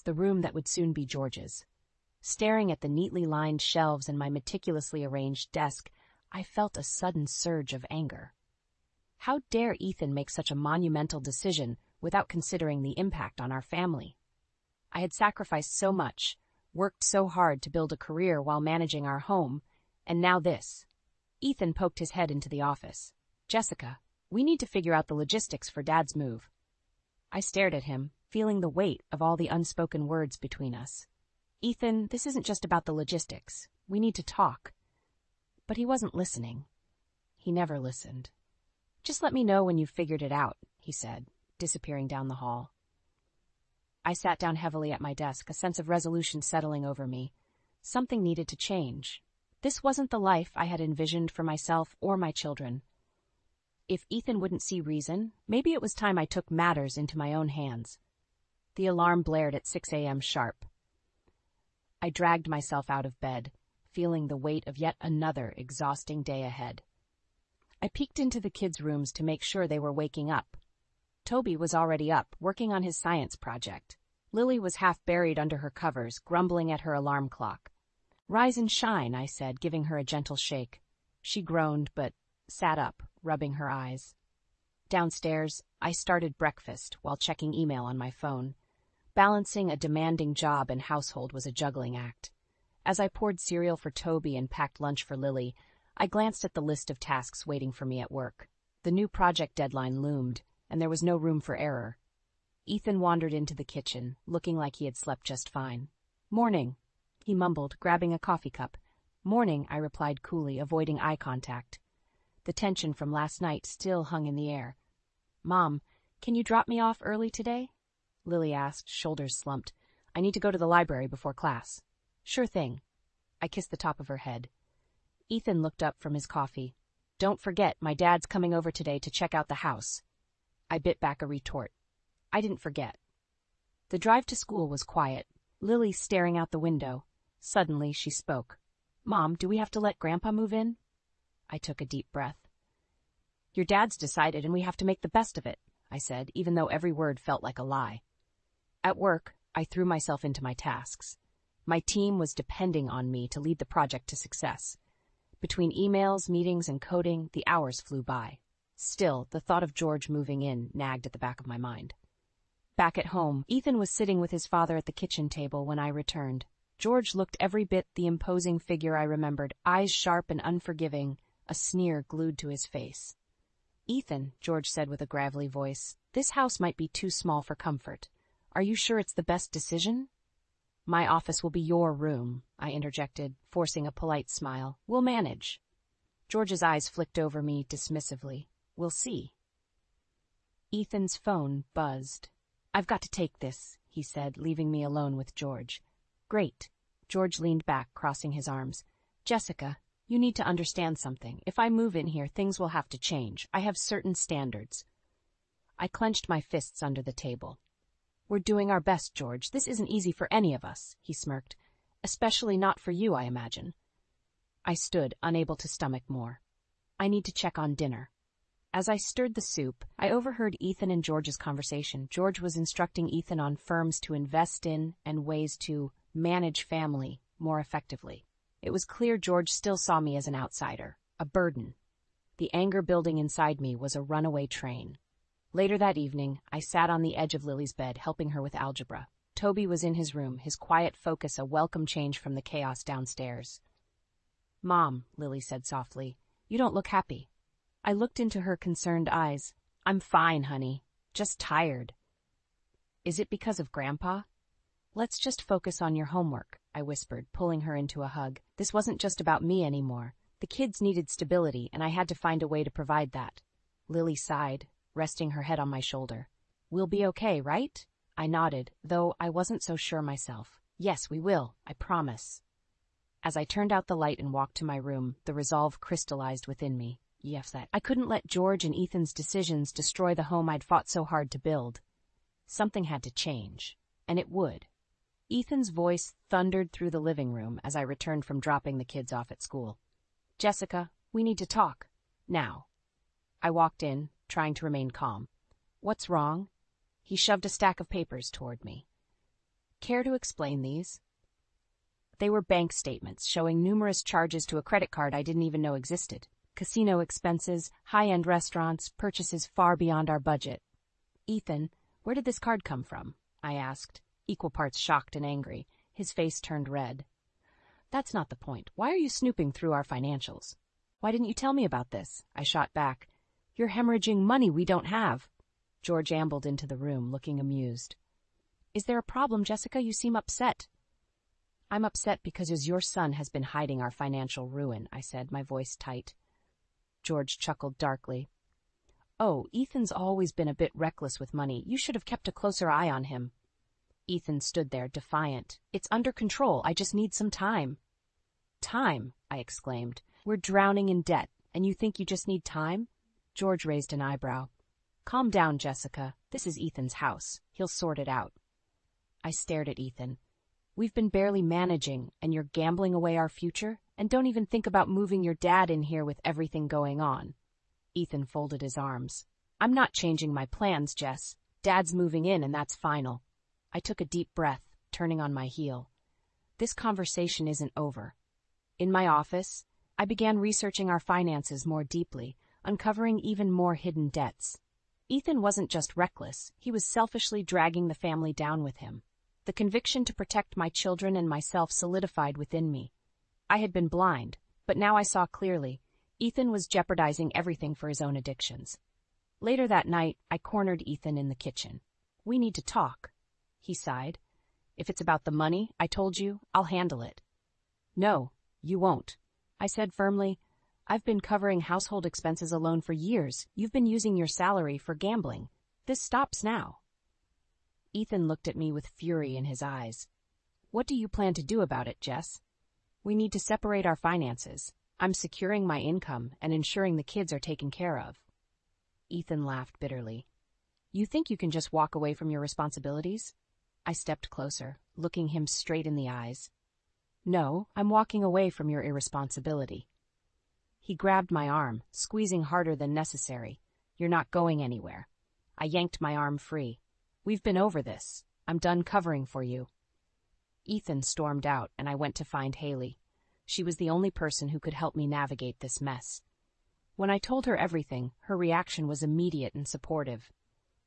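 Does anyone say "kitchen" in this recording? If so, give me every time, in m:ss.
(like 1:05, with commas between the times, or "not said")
1:43, 2:44, 6:41.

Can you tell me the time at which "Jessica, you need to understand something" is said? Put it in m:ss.
3:19.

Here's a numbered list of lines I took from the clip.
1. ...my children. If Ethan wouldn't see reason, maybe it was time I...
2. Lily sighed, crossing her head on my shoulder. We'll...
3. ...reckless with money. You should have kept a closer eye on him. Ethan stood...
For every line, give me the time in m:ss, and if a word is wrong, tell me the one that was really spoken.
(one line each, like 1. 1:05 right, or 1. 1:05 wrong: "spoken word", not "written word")
1. 0:52 right
2. 4:23 wrong: "resting", not "crossing"
3. 5:40 right.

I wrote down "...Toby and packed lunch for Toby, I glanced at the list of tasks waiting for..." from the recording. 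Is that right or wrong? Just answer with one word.
wrong.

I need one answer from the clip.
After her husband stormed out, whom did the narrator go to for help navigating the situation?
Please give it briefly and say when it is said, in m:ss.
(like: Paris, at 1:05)
Haley, at 7:32.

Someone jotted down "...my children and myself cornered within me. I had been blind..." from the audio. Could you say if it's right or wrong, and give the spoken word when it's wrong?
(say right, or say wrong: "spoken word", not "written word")
wrong: "solidified", not "cornered".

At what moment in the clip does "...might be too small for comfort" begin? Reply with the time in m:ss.
2:56.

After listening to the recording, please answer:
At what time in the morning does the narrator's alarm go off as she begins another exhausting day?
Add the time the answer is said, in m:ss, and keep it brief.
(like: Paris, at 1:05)
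6 a.m., at 0:59.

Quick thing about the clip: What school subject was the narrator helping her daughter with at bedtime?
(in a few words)
Algebra.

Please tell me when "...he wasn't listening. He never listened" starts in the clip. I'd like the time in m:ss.
0:35.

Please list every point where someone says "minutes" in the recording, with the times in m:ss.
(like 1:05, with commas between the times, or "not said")
not said.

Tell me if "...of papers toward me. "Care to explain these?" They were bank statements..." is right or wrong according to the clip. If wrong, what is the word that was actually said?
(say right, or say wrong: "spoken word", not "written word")
right.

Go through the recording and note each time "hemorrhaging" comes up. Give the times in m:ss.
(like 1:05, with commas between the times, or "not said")
5:23.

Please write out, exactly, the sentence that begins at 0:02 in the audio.
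Staring at the neatly lined shelves and my meticulously arranged desk, I felt a sudden surge of anger.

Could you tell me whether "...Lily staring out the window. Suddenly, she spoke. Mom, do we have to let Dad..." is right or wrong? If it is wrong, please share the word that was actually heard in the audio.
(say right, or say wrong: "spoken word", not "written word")
wrong: "Grandpa", not "Dad".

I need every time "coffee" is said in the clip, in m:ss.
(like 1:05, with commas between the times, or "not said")
1:48, 2:06.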